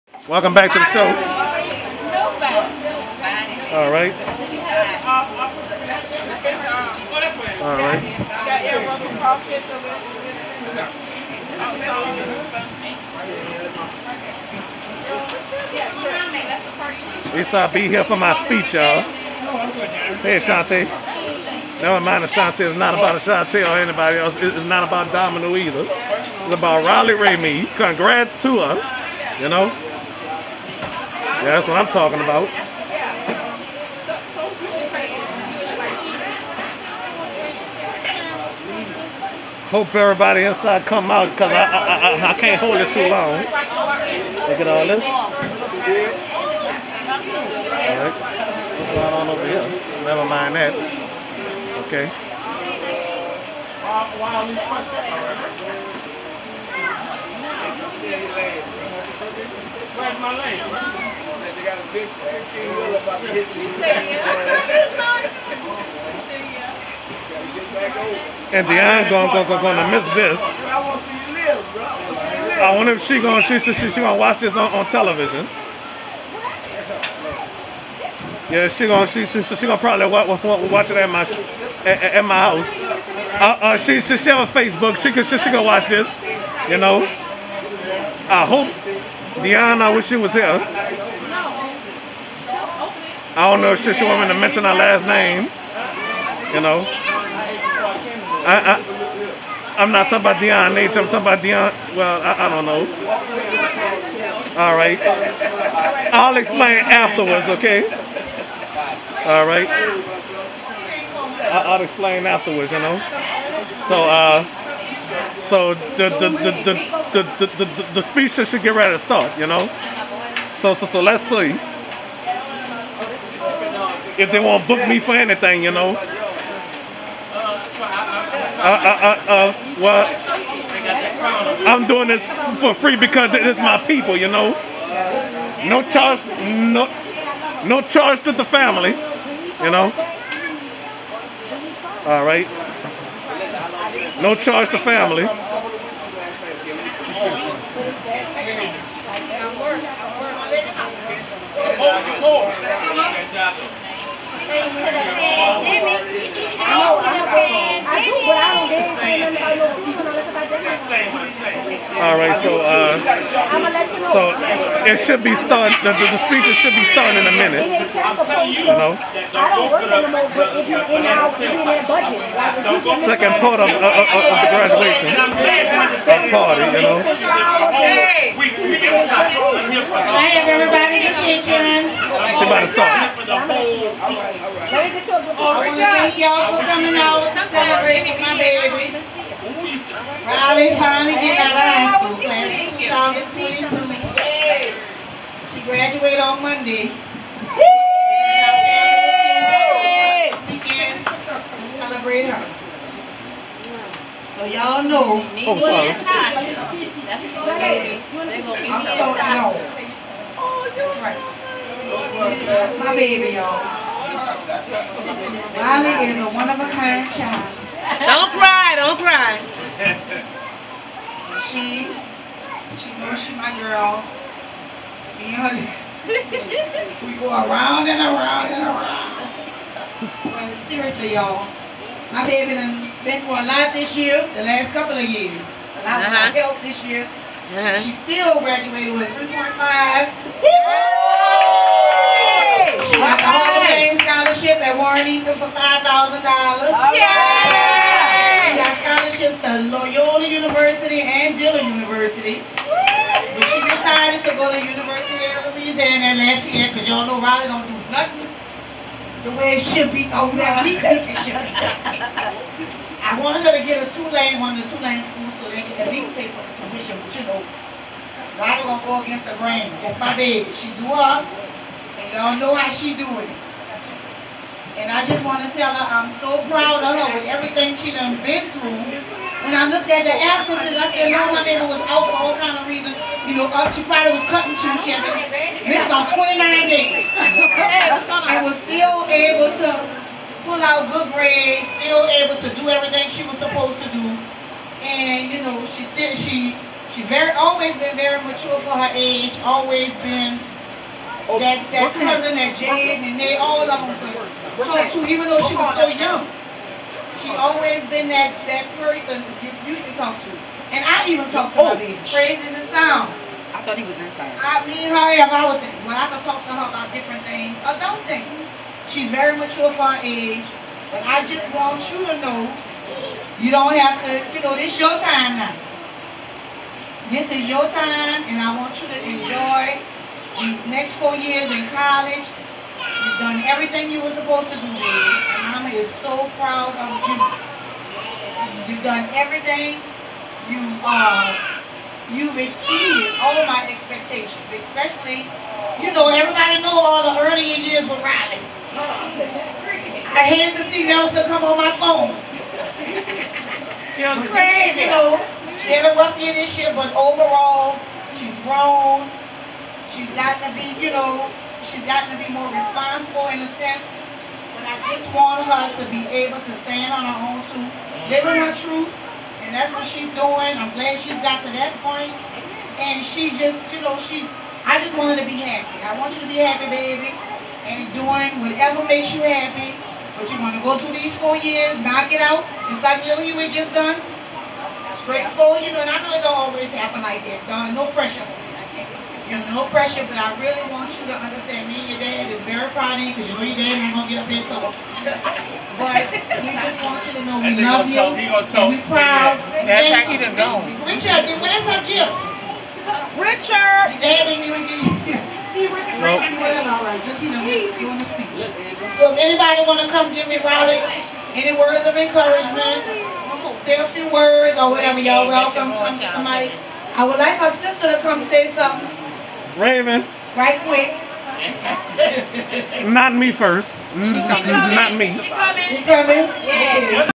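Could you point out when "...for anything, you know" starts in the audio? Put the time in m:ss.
2:05.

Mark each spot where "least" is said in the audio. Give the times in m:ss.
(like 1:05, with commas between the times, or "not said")
0:17, 4:25.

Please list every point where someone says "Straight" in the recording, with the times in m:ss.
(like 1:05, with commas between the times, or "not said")
6:25.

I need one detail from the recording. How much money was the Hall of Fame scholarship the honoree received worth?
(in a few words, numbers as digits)
$5,000.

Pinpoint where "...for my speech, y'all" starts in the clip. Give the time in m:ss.
0:18.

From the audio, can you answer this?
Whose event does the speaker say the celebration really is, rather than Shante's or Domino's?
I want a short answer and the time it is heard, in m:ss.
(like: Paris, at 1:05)
Riley Ramey, at 0:26.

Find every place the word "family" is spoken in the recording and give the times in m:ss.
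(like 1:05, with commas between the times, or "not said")
2:18, 5:35.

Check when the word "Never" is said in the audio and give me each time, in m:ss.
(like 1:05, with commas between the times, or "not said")
0:21, 0:50.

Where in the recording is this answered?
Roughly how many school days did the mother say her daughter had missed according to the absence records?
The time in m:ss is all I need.
4:46.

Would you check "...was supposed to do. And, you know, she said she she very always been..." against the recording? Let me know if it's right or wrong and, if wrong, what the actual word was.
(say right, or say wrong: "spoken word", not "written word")
right.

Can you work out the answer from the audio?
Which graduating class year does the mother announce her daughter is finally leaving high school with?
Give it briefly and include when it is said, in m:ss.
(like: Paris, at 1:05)
2022, at 3:12.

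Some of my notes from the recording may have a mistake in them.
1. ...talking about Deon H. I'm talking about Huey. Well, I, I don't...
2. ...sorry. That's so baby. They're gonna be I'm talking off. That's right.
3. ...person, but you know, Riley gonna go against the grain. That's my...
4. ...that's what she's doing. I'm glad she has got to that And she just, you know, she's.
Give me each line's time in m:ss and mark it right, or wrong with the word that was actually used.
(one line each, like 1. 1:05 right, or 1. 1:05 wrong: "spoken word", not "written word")
1. 1:40 wrong: "Dion", not "Huey"
2. 3:25 wrong: "starting", not "talking"
3. 4:26 wrong: "tuition", not "person"
4. 6:09 right.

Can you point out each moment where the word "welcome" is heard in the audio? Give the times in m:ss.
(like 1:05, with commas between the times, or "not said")
0:00, 6:55.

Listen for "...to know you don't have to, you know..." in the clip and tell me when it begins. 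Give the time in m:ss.
5:22.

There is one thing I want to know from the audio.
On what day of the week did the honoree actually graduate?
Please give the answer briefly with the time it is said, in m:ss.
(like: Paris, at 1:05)
Monday, at 3:16.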